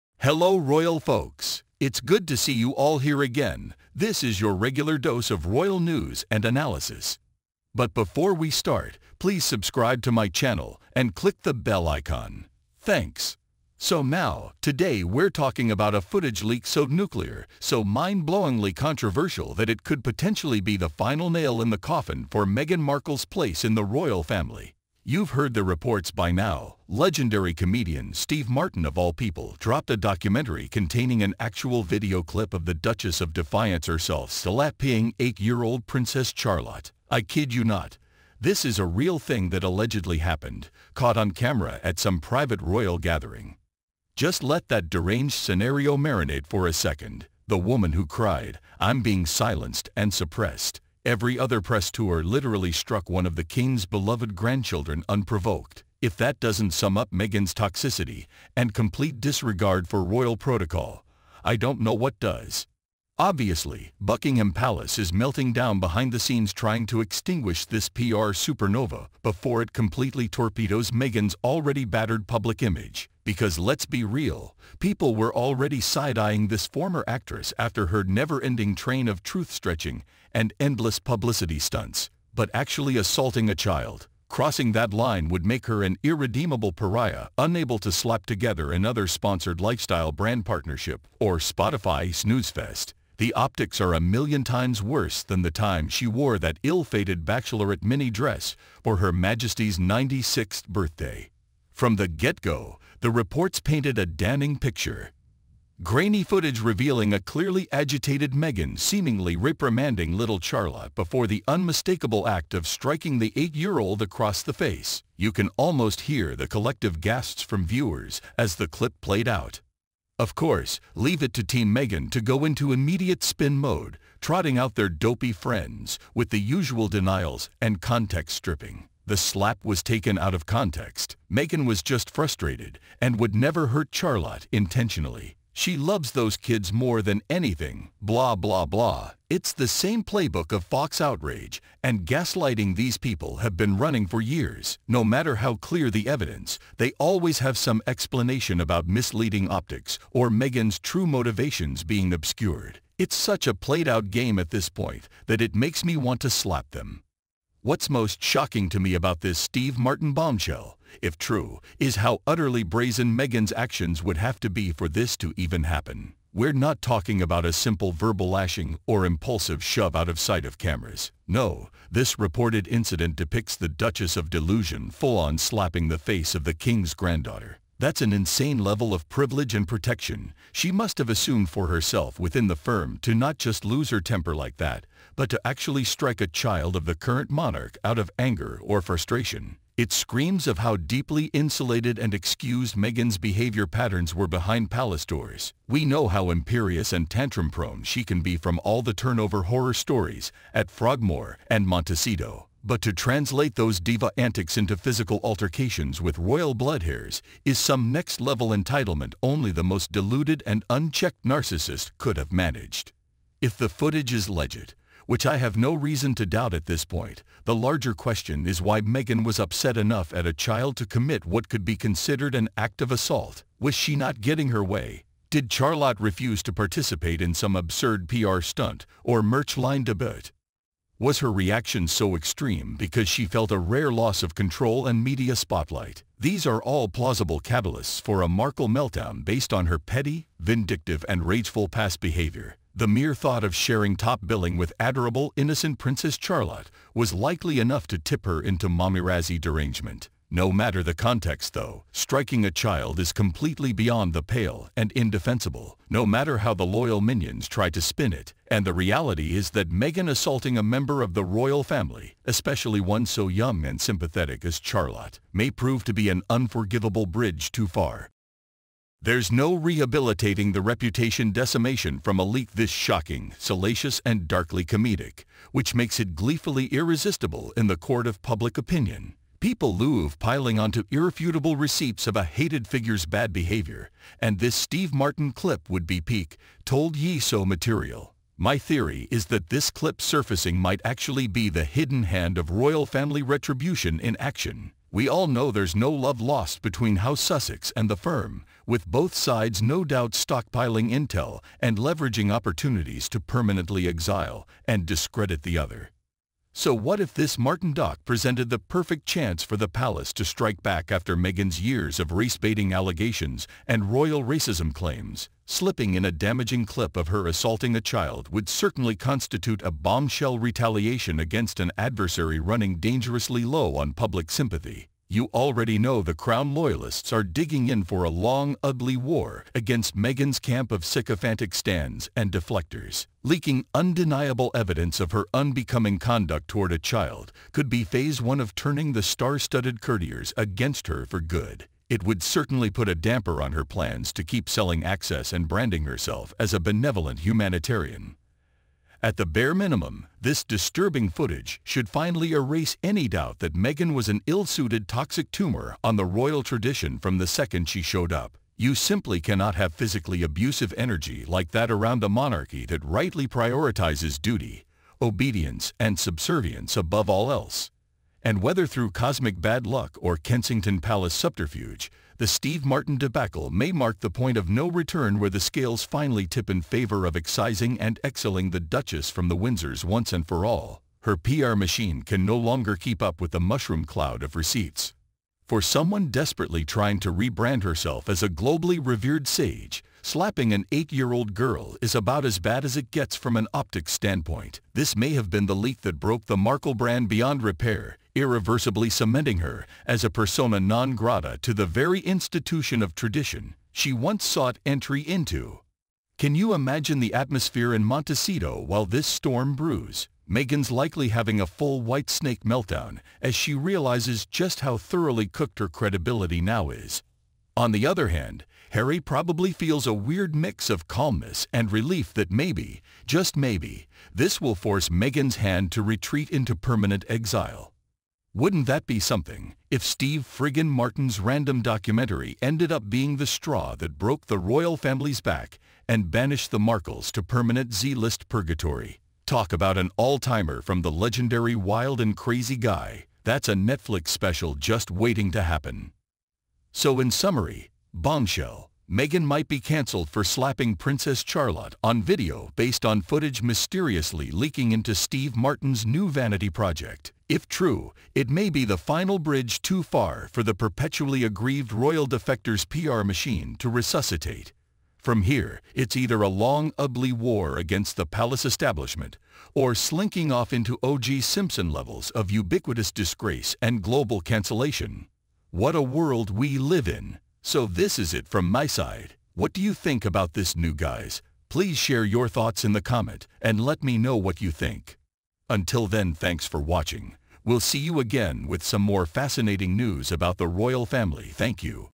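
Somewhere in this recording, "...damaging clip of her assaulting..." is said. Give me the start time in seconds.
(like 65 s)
316 s.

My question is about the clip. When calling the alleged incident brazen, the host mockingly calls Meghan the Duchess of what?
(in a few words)
Delusion.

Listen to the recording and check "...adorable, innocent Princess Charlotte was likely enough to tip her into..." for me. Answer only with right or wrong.
right.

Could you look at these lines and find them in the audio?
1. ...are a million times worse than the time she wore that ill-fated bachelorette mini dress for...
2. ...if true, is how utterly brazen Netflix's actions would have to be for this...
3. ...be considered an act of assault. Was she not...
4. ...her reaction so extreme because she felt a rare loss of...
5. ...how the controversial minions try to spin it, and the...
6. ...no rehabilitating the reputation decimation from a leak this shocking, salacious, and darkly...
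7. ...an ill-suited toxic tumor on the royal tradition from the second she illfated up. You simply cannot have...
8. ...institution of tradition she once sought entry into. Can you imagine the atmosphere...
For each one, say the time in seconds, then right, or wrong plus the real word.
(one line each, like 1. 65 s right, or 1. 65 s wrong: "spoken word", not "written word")
1. 93 s right
2. 160 s wrong: "Meghan", not "Netflix"
3. 221 s right
4. 231 s right
5. 256 s wrong: "loyal", not "controversial"
6. 269 s right
7. 354 s wrong: "showed", not "illfated"
8. 402 s right.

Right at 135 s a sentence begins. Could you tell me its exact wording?
She loves those kids more than anything, blah, blah, blah.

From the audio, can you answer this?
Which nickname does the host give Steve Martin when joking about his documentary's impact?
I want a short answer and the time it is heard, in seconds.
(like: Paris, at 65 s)
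Wild and Crazy Guy, at 441 s.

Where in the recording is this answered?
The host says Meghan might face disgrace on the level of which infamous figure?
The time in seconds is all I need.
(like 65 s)
470 s.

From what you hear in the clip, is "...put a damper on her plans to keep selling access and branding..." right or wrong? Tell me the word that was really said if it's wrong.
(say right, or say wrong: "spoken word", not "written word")
right.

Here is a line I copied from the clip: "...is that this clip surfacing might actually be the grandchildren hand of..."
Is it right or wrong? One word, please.
wrong.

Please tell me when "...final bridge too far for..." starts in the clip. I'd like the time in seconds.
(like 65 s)
458 s.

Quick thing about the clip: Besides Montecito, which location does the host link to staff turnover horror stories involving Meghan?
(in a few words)
Frogmore.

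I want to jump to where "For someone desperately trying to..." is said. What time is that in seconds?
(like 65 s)
385 s.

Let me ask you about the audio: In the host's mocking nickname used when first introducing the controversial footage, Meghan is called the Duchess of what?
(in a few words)
Defiance.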